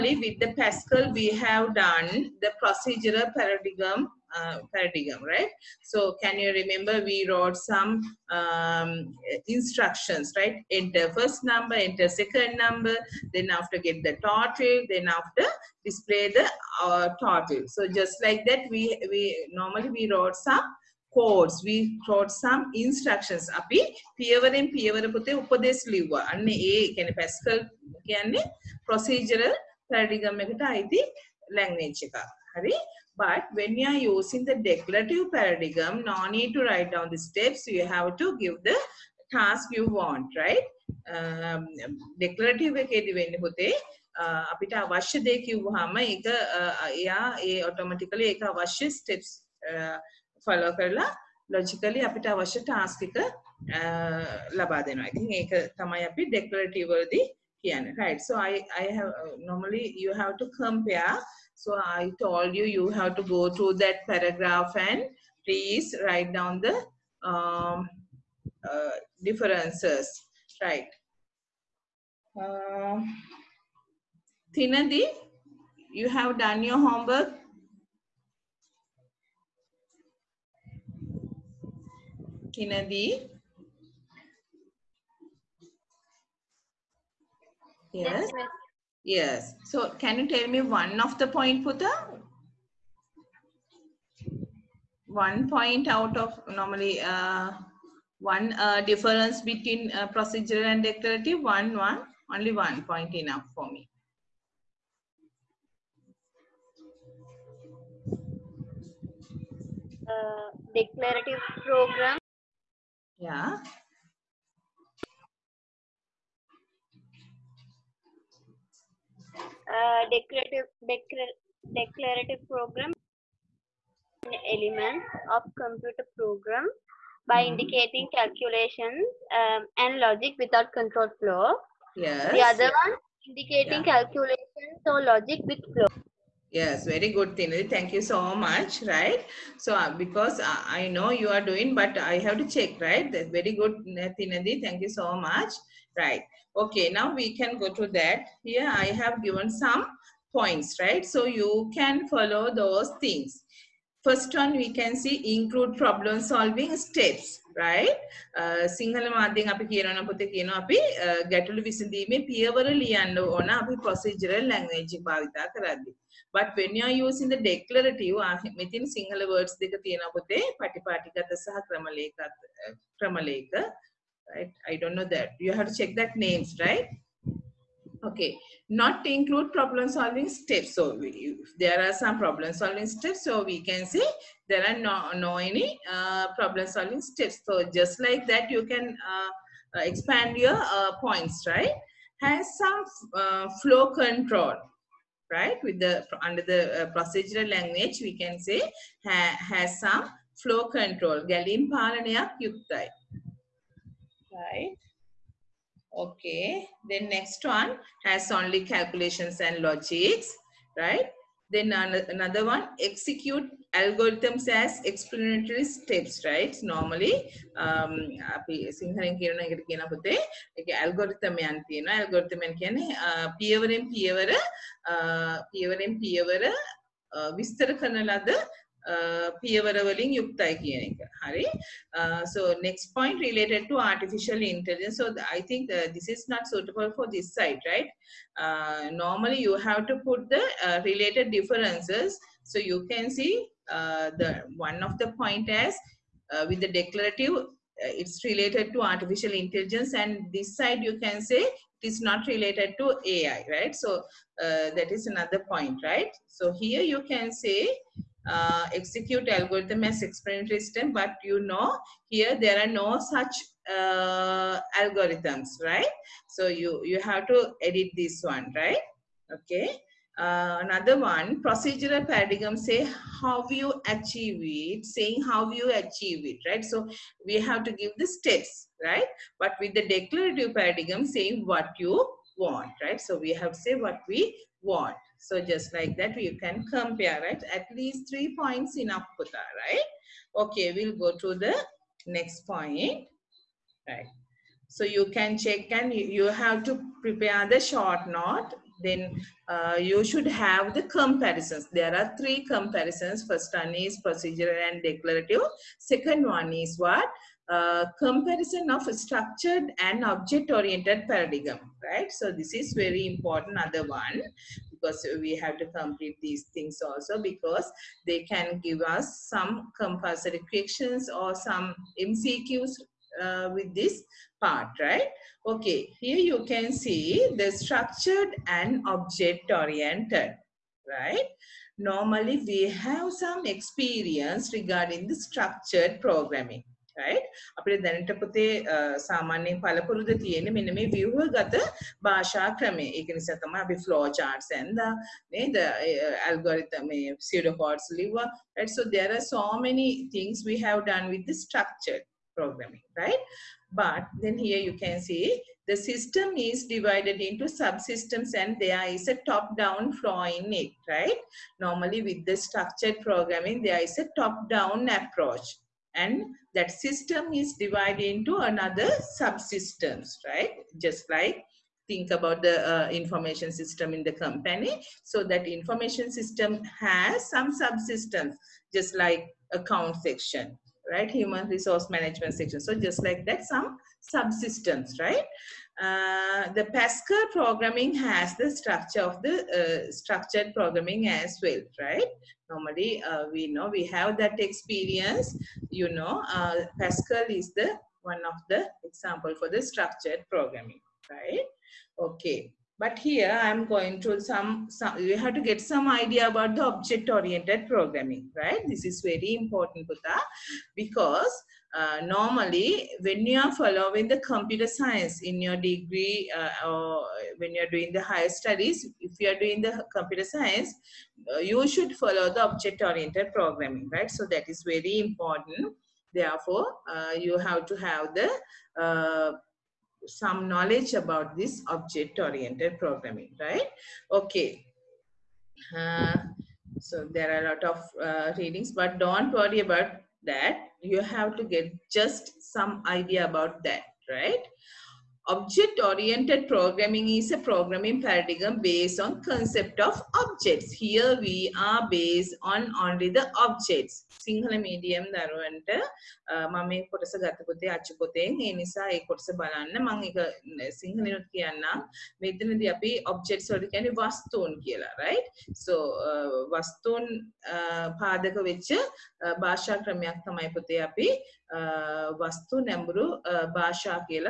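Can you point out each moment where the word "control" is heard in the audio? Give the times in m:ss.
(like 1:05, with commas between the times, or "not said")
2:10, 3:13, 3:20.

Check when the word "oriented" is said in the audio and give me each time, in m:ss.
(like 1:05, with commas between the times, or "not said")
5:10, 5:28, 6:47, 7:02, 7:11, 7:25.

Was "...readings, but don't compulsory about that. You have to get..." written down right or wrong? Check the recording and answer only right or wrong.
wrong.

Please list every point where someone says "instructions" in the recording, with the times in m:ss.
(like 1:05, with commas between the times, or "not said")
0:09, 0:22.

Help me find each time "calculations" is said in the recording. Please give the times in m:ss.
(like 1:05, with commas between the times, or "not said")
2:08, 2:13, 3:28.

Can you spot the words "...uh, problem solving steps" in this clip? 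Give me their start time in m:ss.
3:05.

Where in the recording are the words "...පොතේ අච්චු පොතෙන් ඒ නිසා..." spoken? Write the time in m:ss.
7:37.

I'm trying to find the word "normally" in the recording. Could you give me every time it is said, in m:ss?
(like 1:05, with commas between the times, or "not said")
0:19, 1:36, 3:36, 3:59, 5:31, 6:01, 6:32, 6:52.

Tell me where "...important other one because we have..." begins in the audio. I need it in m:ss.
5:13.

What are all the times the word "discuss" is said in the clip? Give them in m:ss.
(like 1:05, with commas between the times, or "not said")
not said.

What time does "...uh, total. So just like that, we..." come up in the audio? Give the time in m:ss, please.
0:16.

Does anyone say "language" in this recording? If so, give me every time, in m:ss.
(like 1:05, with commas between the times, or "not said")
0:31, 3:17.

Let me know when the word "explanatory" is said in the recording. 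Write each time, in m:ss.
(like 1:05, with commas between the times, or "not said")
3:34, 4:20.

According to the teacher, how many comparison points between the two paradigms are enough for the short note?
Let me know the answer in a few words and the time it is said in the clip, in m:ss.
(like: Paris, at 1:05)
3, at 4:47.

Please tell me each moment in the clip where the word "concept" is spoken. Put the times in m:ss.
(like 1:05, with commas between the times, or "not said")
7:29.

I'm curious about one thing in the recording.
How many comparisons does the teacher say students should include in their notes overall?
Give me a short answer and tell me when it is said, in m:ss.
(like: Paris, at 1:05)
3, at 5:01.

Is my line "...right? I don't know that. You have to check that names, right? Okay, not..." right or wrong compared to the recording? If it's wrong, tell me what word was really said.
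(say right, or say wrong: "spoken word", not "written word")
right.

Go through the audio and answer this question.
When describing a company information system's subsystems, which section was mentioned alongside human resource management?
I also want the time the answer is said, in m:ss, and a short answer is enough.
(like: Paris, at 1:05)
Account section, at 6:19.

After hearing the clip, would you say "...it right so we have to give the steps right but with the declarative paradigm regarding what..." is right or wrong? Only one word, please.
wrong.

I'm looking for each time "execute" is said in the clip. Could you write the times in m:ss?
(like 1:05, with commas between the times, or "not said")
3:32, 4:18.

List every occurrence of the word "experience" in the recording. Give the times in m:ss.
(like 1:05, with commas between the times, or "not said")
5:33, 6:34.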